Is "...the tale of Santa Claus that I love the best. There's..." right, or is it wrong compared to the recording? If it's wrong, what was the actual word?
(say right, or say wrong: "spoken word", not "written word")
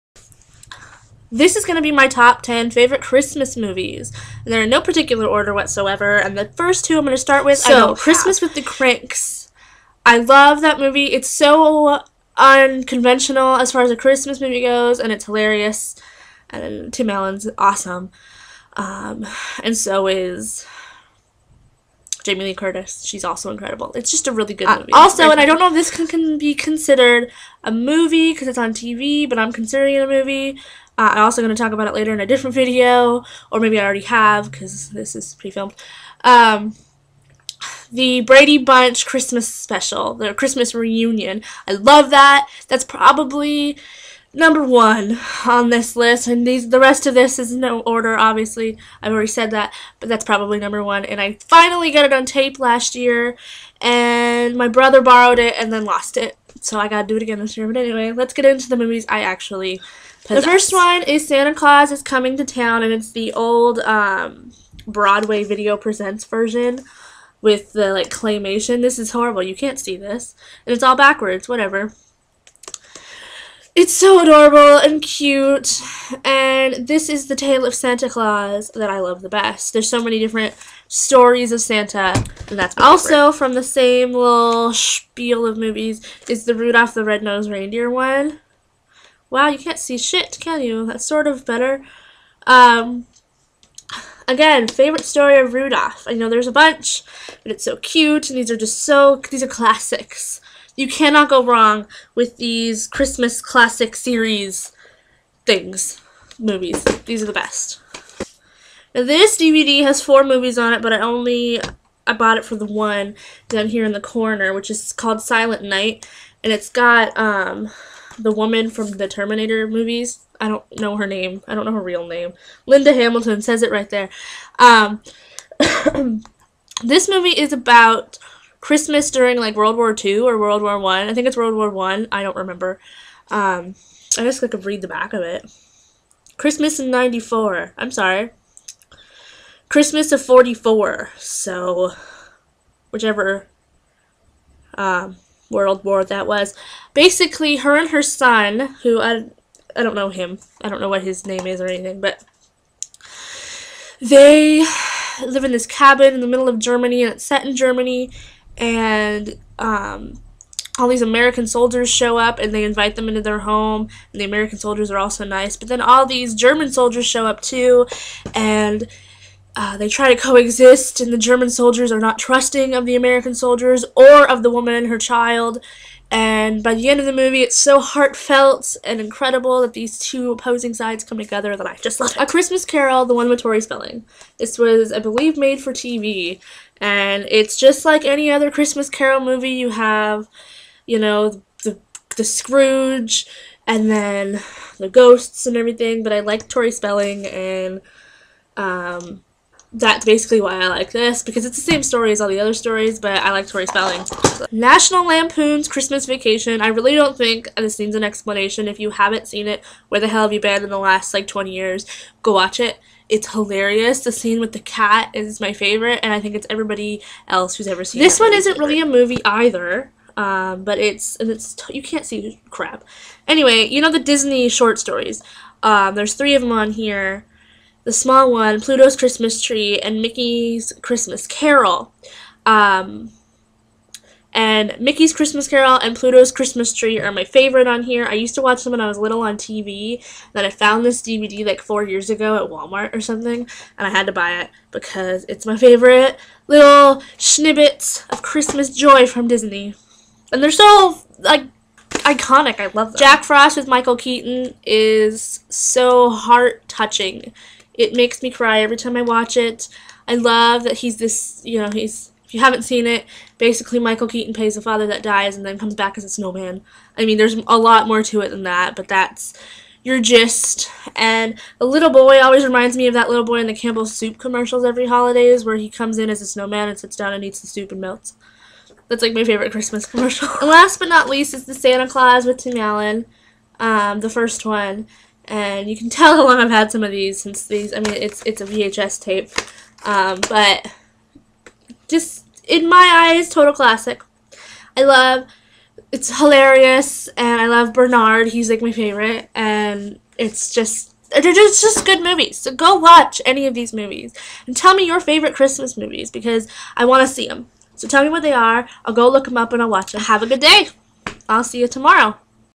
right.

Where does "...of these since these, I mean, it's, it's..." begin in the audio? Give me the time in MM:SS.
04:46.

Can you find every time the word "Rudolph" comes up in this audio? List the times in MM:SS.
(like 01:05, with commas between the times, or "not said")
01:26, 01:35.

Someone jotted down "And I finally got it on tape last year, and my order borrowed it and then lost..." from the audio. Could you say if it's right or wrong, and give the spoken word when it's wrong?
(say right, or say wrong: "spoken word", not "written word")
wrong: "brother", not "order".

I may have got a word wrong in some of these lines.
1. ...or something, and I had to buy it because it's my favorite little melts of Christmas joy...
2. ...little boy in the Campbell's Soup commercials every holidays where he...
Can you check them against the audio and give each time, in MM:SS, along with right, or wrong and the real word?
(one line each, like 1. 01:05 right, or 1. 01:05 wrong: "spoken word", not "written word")
1. 04:02 wrong: "snippets", not "melts"
2. 04:33 right.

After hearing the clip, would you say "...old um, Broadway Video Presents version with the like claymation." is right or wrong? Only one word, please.
right.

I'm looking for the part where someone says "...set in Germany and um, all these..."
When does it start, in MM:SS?
02:37.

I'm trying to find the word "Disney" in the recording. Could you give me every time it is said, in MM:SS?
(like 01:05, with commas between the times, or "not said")
03:43, 04:09.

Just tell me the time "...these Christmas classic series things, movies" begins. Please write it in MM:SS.
01:42.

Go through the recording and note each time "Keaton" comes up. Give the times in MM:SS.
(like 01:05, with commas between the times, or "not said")
04:13, 04:24.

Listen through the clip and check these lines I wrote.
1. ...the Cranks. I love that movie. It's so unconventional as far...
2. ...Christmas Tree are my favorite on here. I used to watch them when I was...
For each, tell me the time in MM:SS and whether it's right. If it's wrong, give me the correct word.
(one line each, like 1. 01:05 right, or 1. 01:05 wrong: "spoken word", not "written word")
1. 00:08 right
2. 03:56 right.